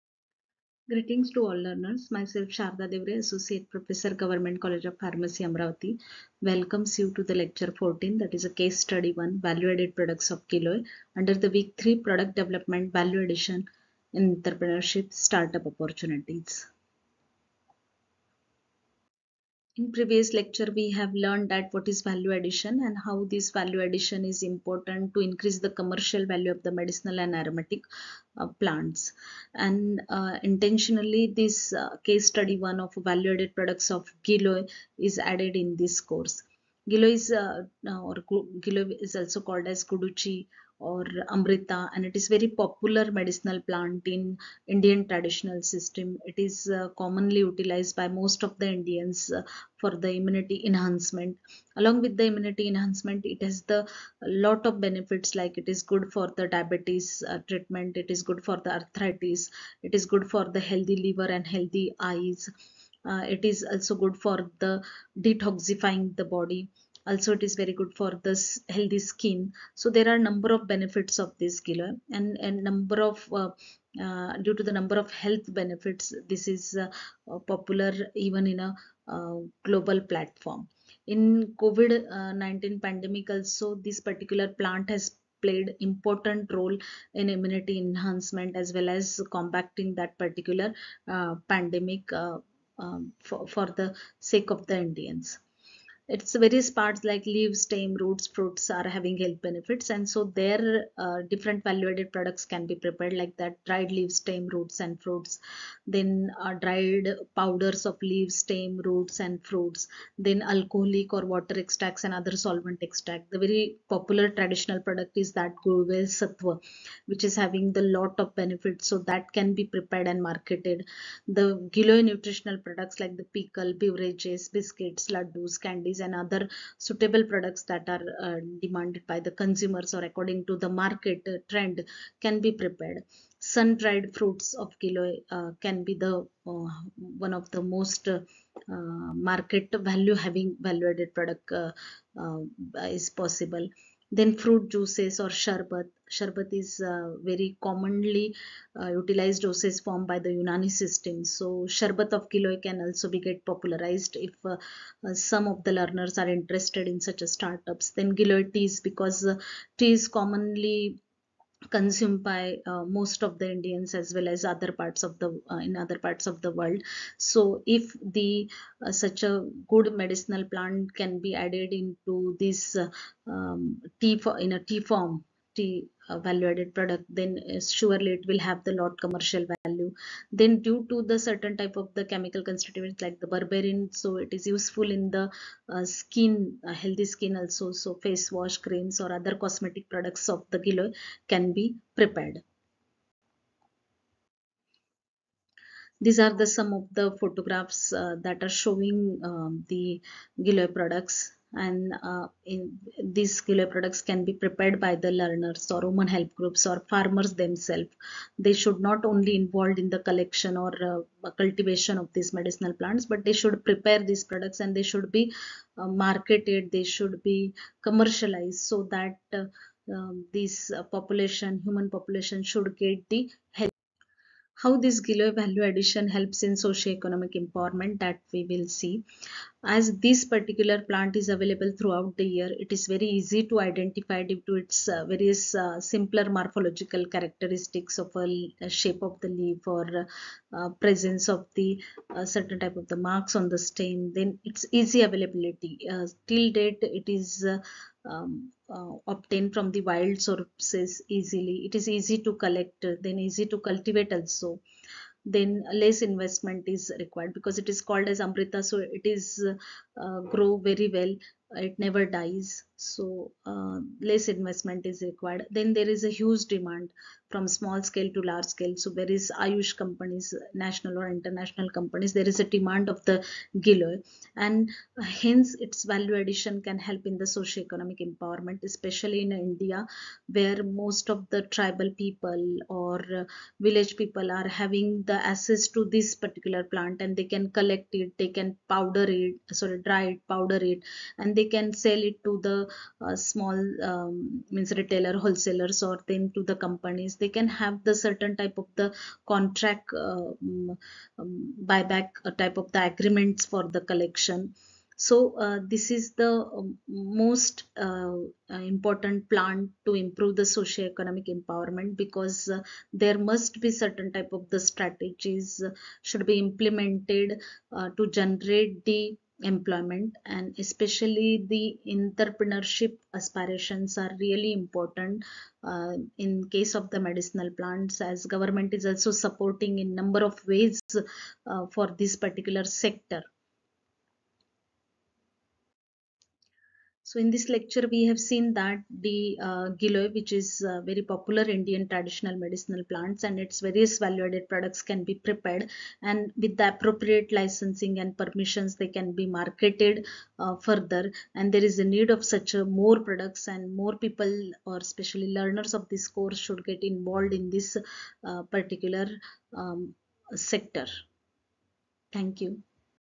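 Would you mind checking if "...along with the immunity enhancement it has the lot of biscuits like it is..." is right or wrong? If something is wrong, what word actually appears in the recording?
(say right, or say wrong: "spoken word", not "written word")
wrong: "benefits", not "biscuits".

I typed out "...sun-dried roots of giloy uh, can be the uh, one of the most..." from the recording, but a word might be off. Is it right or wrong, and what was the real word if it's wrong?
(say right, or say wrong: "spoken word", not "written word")
wrong: "fruits", not "roots".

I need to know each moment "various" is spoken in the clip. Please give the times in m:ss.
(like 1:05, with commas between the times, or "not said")
1:36, 3:55, 5:43.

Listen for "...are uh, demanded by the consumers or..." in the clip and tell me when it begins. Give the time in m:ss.
2:07.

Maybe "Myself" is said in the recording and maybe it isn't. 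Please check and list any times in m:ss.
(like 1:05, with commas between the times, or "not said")
0:02.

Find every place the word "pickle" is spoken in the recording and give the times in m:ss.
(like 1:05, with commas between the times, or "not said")
2:03.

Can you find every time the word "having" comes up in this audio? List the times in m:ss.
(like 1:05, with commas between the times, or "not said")
1:38, 1:57, 2:20, 4:44.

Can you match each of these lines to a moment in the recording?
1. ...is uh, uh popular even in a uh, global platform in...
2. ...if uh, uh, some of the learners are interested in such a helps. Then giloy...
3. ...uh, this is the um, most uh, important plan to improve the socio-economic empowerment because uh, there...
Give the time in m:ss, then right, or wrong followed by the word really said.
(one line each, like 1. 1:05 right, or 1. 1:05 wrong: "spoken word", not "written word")
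1. 1:16 right
2. 2:34 wrong: "startups", not "helps"
3. 5:05 right.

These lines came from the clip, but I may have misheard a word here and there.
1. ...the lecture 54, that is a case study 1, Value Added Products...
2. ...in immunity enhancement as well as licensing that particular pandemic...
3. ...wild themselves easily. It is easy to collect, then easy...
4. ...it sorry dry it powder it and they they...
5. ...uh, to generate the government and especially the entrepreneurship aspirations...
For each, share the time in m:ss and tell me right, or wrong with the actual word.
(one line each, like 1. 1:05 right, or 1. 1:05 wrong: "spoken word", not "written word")
1. 0:07 wrong: "14", not "54"
2. 1:27 wrong: "combating", not "licensing"
3. 4:09 wrong: "sources", not "themselves"
4. 4:49 right
5. 5:17 wrong: "employment", not "government".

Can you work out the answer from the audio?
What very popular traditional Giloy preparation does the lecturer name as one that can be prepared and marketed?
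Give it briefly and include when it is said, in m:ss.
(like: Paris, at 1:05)
Gulvel satwa, at 1:55.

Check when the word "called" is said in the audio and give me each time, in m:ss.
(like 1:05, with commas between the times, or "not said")
0:39, 4:17.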